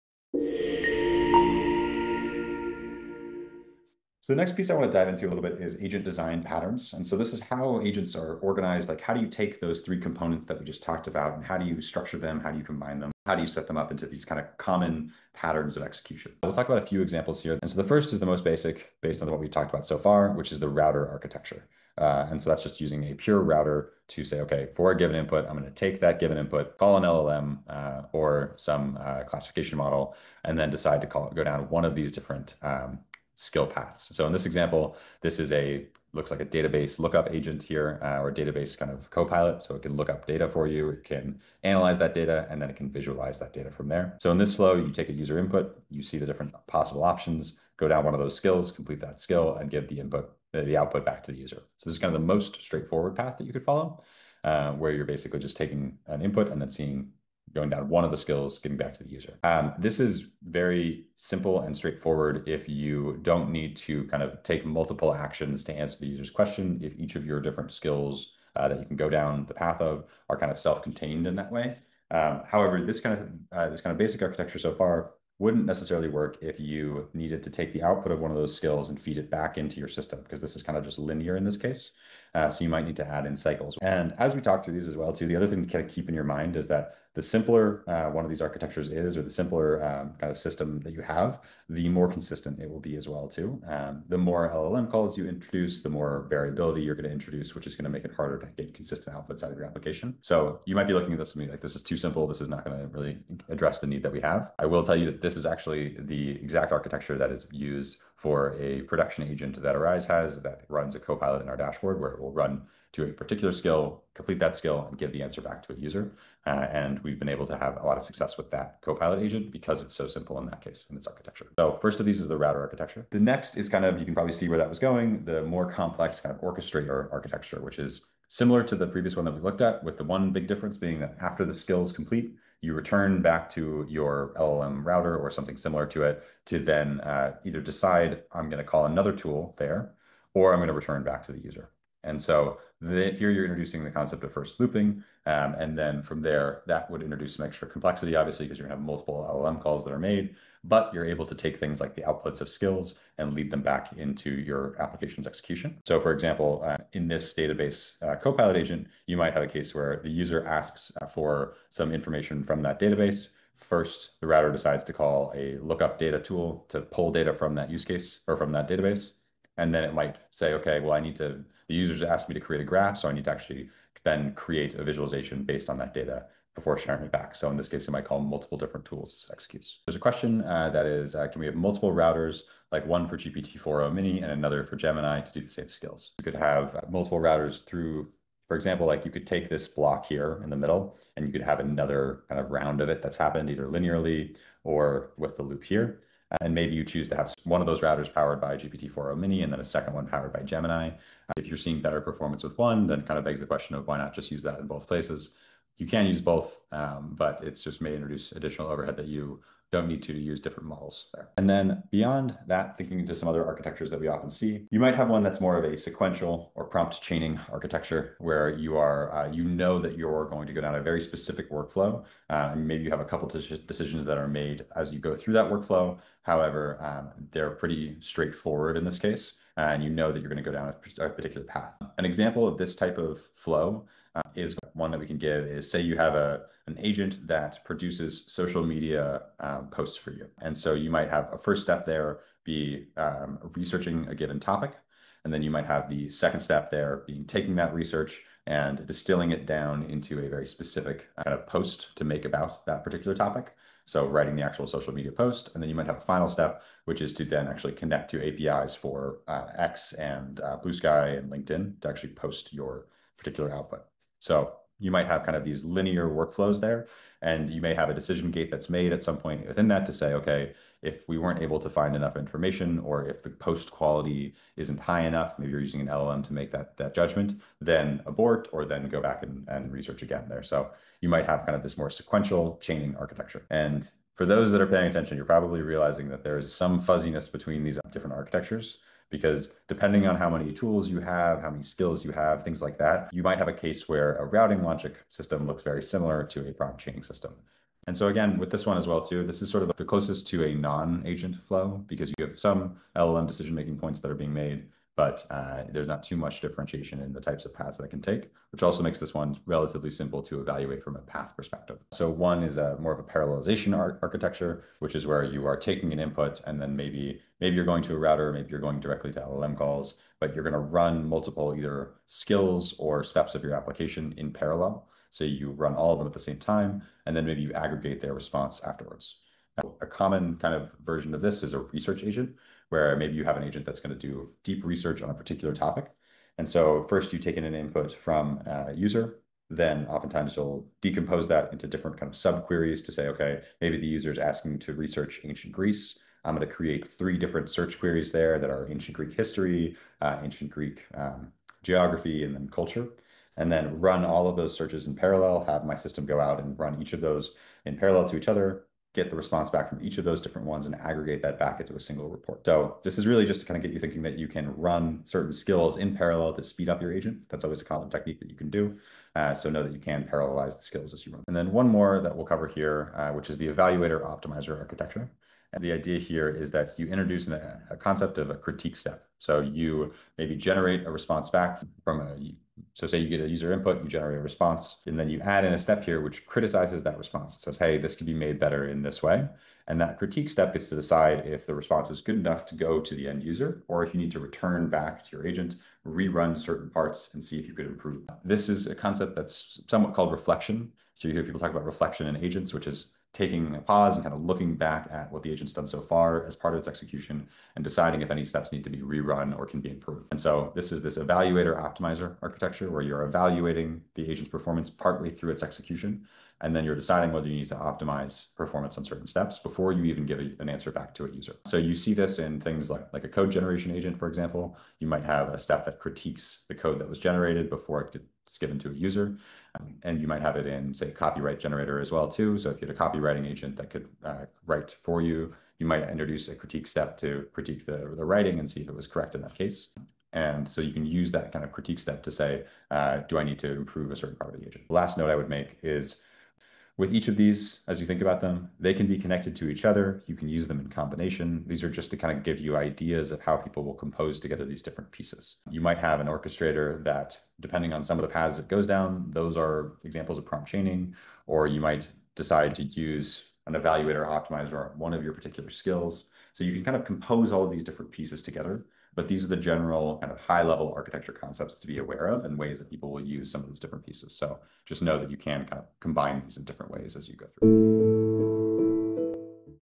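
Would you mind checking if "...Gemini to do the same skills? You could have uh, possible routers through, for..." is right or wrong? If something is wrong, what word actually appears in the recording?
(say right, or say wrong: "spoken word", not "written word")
wrong: "multiple", not "possible".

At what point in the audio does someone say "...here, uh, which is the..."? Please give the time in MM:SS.
06:12.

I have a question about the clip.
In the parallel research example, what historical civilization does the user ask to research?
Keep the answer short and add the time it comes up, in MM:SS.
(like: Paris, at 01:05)
Ancient Greece, at 05:45.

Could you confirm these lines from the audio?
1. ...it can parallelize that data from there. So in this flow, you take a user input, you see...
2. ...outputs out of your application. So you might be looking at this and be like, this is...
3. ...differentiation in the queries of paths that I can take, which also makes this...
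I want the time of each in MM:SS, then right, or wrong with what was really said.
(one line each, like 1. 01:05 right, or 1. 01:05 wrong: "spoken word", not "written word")
1. 00:42 wrong: "visualize", not "parallelize"
2. 01:39 right
3. 05:06 wrong: "types", not "queries".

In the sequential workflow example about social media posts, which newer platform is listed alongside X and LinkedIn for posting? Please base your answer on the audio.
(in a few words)
Bluesky.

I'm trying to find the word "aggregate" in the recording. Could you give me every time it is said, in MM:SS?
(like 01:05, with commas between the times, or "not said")
05:27, 06:00.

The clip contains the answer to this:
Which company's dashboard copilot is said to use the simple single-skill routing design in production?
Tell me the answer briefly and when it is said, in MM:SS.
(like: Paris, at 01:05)
Arize, at 01:49.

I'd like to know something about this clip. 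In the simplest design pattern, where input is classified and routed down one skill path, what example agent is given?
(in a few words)
Database lookup agent.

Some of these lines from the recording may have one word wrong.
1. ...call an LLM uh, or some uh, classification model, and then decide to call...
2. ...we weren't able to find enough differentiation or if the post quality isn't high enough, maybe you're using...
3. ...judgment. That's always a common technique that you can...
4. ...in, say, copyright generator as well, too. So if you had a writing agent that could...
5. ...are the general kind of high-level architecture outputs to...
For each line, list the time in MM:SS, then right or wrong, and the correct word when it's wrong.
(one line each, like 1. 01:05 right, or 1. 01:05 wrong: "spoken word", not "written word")
1. 00:26 right
2. 04:31 wrong: "information", not "differentiation"
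3. 06:06 wrong: "agent", not "judgment"
4. 07:10 wrong: "copywriting", not "writing"
5. 07:49 wrong: "concepts", not "outputs".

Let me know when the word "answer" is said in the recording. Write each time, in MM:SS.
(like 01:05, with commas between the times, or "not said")
01:05, 01:55, 07:00.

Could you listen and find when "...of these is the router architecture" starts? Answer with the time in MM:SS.
02:01.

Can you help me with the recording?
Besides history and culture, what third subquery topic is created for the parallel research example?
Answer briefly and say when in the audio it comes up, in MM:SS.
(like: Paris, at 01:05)
Geography, at 05:51.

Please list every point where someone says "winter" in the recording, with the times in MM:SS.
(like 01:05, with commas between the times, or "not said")
not said.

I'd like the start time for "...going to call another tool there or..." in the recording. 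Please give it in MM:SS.
02:18.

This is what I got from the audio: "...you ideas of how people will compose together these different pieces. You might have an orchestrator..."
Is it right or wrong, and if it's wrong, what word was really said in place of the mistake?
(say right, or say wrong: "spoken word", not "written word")
right.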